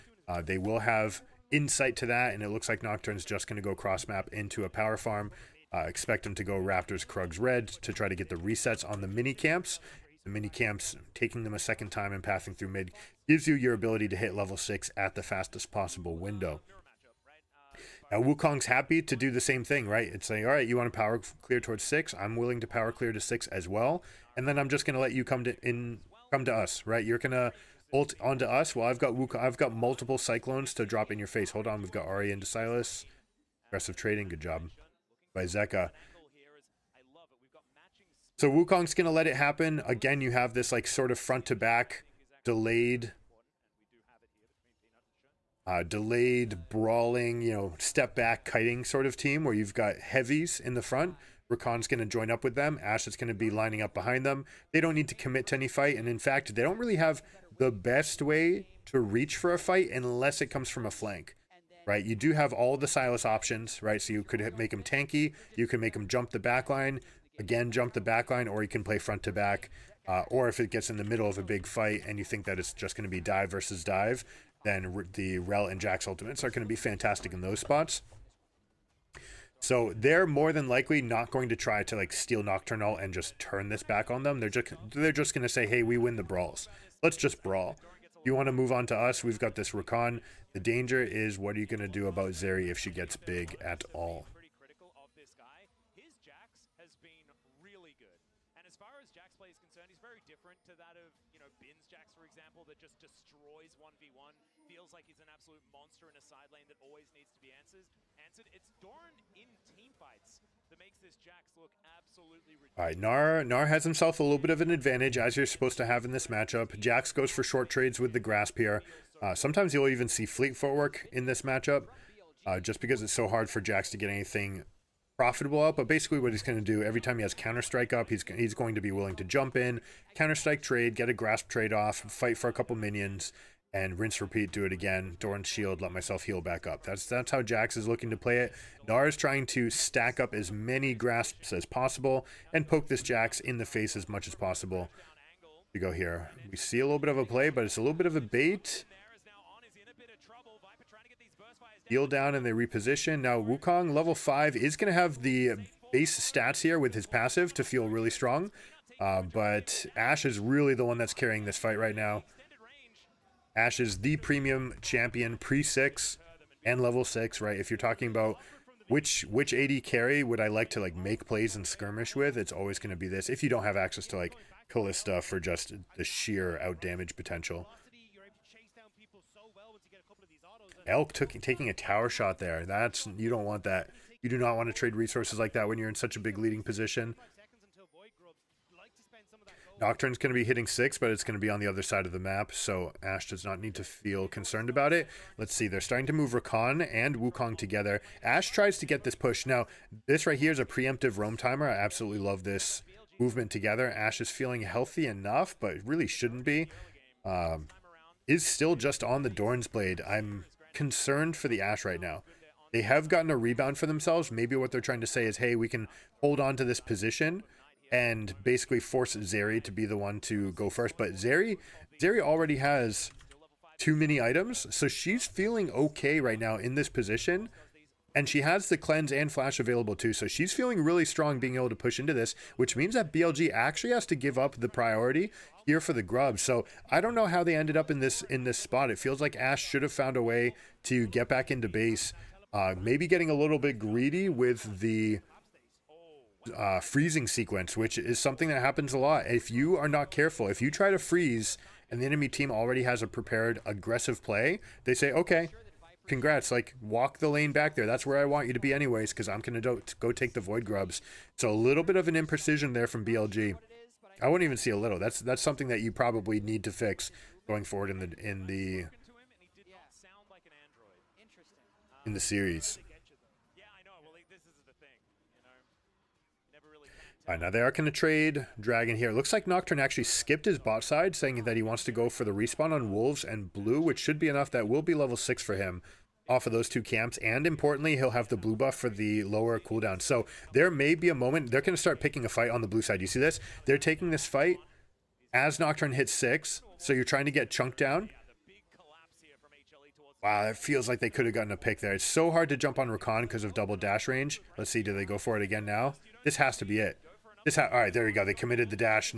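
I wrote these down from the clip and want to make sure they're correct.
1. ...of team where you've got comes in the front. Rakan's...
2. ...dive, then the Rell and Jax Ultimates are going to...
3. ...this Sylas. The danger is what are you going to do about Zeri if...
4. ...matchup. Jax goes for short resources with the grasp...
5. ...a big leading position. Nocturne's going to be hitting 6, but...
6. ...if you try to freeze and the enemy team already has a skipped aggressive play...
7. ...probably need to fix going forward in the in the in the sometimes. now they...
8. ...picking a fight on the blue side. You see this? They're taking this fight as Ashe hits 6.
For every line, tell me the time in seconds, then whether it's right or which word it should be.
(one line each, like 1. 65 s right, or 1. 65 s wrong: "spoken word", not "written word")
1. 49 s wrong: "heavies", not "comes"
2. 73 s right
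3. 89 s wrong: "Rakan", not "Sylas"
4. 116 s wrong: "trades", not "resources"
5. 186 s right
6. 250 s wrong: "prepared", not "skipped"
7. 265 s wrong: "series", not "sometimes"
8. 291 s wrong: "Nocturne", not "Ashe".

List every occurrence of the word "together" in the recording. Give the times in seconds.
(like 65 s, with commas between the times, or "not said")
197 s, 203 s.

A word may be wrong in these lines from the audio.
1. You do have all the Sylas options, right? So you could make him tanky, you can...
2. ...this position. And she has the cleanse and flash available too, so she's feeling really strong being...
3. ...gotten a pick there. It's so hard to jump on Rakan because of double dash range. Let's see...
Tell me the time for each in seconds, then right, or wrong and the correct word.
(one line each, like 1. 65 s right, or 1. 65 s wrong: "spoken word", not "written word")
1. 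62 s right
2. 226 s right
3. 301 s right.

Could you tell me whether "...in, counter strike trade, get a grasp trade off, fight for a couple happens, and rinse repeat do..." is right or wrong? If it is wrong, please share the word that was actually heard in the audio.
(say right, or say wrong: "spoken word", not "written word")
wrong: "minions", not "happens".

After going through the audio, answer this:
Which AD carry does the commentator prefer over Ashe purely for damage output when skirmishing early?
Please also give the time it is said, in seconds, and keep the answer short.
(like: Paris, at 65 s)
Kalista, at 174 s.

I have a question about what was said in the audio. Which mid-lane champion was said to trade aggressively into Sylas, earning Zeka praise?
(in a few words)
Ahri.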